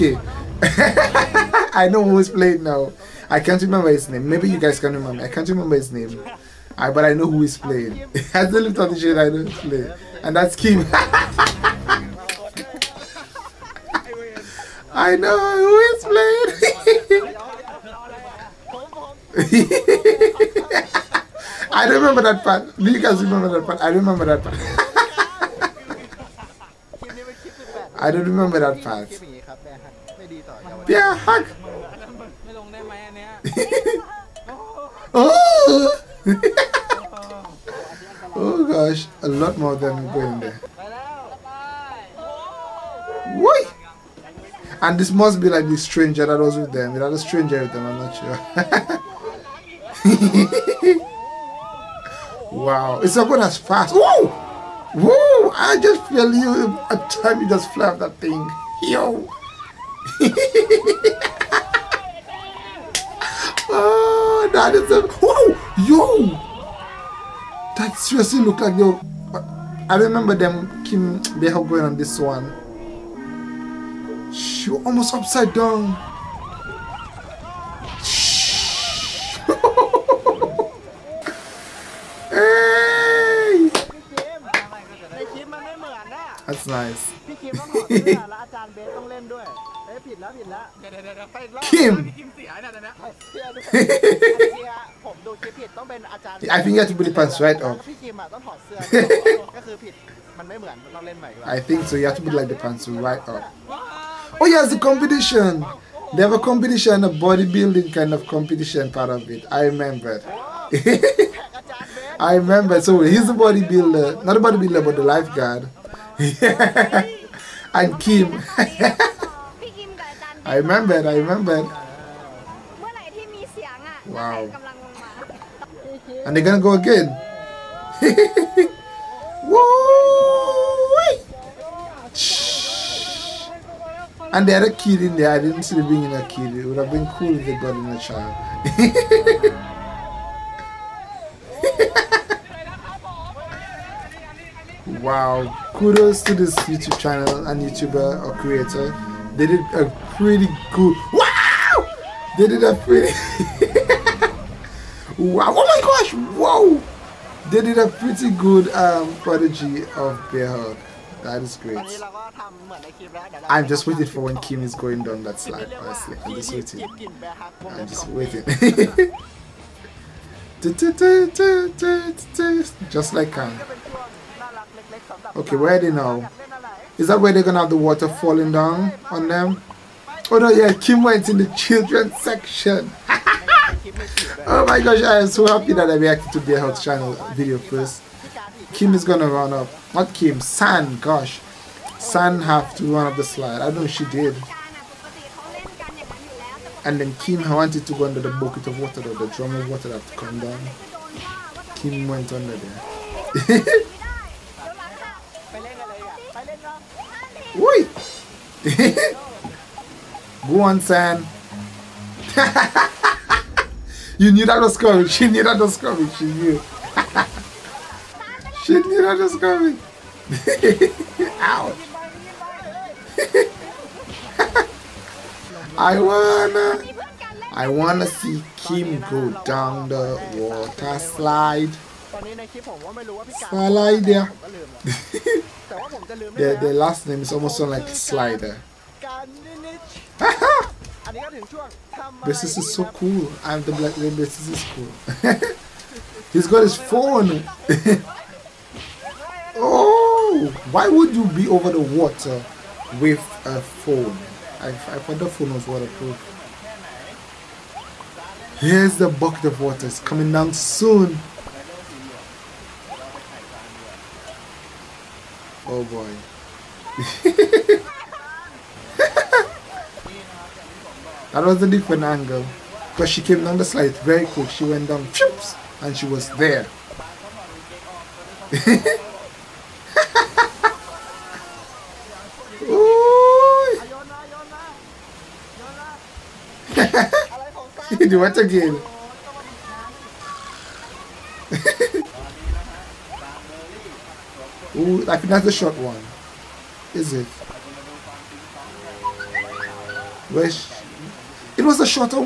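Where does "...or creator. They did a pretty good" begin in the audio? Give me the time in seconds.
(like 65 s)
148 s.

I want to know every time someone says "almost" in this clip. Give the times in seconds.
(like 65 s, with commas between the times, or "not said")
74 s, 237 s.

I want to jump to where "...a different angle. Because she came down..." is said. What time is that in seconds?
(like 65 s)
271 s.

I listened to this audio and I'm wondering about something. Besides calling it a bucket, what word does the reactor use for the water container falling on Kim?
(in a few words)
drum.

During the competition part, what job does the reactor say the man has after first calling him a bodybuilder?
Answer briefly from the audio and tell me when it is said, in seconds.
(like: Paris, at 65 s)
lifeguard, at 115 s.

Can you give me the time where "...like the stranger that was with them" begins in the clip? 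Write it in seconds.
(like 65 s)
45 s.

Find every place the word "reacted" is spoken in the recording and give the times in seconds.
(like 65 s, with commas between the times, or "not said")
185 s.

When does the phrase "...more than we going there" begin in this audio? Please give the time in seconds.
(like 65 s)
39 s.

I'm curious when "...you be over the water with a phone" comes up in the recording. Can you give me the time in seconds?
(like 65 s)
251 s.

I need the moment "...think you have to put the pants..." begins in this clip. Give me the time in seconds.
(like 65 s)
96 s.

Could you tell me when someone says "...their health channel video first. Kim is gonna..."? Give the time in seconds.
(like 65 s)
186 s.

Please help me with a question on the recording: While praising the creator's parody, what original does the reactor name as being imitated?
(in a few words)
Bear Hug.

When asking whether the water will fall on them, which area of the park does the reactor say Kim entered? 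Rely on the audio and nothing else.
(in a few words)
children's section.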